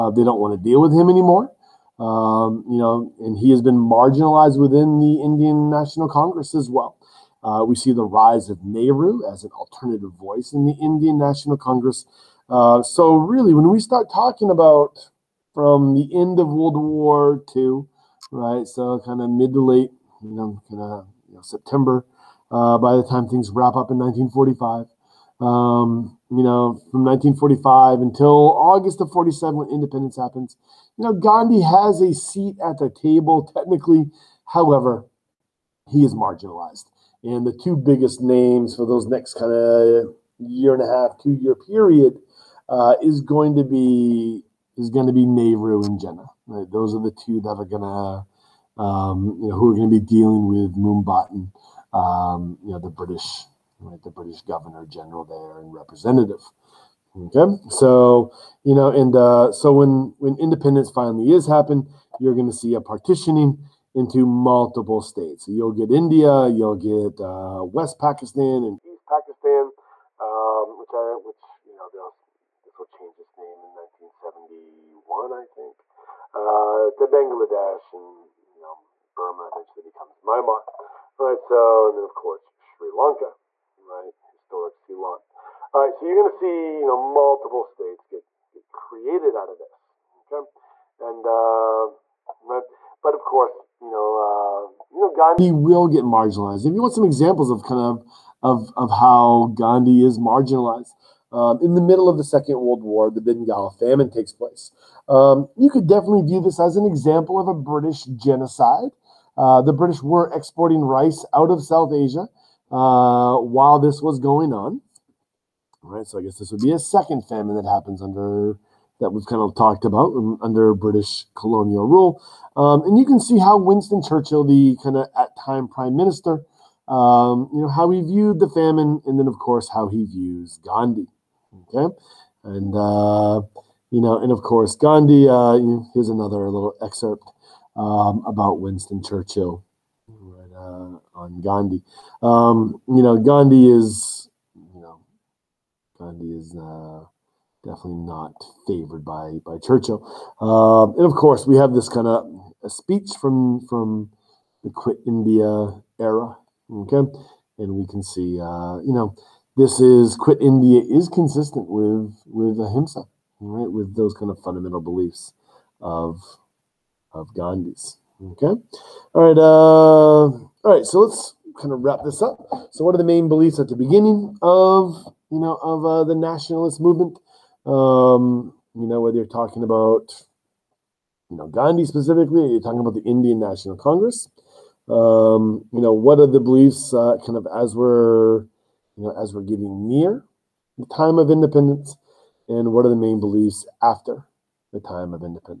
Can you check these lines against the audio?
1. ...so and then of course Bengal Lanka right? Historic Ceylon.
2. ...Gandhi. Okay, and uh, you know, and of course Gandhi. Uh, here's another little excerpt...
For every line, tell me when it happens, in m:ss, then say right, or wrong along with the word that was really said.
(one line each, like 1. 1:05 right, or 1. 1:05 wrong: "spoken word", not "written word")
1. 1:21 wrong: "Sri", not "Bengal"
2. 2:10 right.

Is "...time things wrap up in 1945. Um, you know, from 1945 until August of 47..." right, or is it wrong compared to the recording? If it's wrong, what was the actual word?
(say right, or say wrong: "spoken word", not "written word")
right.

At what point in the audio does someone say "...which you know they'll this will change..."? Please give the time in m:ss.
1:11.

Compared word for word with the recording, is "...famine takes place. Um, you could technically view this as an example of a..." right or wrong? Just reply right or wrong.
wrong.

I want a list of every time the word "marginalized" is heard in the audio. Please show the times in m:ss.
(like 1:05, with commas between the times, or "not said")
0:03, 0:36, 1:36, 1:40.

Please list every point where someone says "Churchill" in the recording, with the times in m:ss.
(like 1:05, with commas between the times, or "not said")
2:04, 2:19, 2:29.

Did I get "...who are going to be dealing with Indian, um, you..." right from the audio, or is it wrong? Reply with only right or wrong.
wrong.